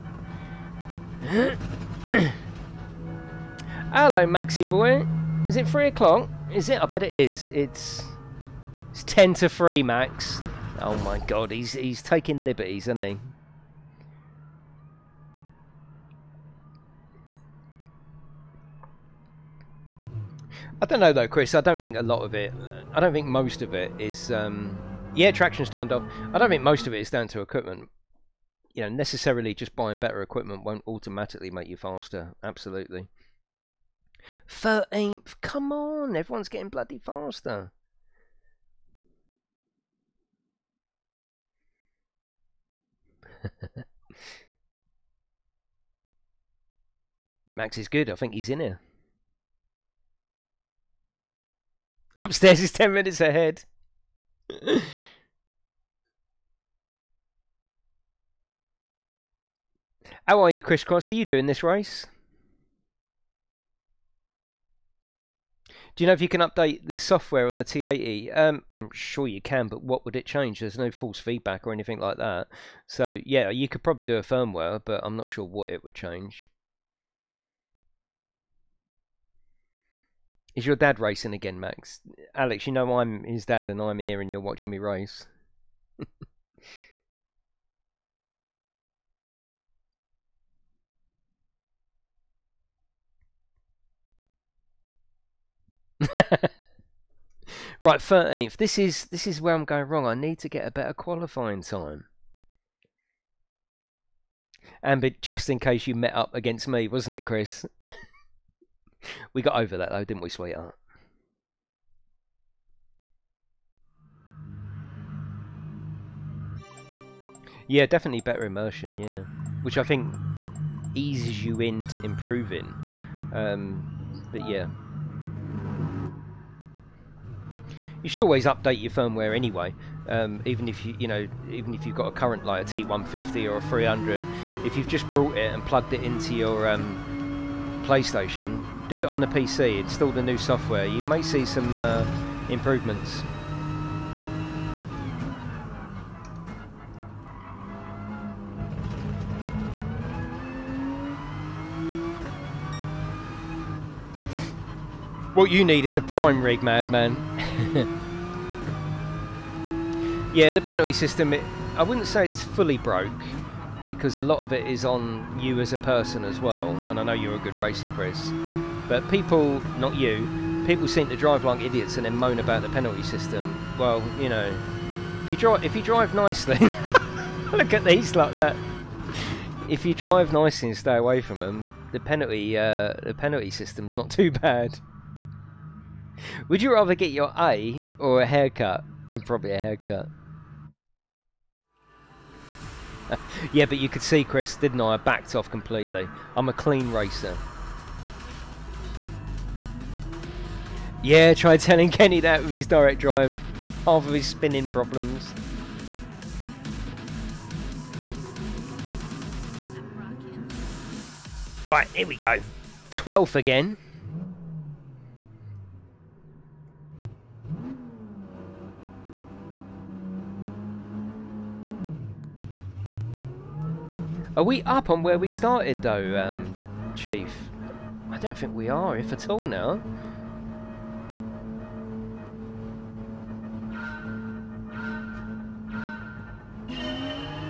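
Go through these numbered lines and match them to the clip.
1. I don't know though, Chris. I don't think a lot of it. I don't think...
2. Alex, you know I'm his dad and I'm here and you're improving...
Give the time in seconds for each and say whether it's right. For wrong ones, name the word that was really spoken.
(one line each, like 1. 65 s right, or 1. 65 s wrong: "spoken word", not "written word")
1. 20 s right
2. 82 s wrong: "watching", not "improving".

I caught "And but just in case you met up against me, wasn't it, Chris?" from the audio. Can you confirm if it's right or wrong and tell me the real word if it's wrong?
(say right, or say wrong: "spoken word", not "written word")
right.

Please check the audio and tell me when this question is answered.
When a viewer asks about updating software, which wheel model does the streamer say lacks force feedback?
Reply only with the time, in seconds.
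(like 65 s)
67 s.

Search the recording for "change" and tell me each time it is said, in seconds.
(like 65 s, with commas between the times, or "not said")
70 s, 75 s.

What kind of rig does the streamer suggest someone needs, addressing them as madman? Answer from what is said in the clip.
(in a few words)
prime rig.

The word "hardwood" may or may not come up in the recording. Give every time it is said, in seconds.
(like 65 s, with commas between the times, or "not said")
not said.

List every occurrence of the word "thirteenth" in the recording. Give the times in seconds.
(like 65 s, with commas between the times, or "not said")
34 s, 97 s.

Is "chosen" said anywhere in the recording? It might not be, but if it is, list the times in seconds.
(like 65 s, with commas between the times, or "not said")
not said.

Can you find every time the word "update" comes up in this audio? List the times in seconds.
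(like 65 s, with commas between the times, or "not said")
66 s, 128 s.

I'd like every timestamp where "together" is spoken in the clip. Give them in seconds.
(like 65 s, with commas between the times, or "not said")
not said.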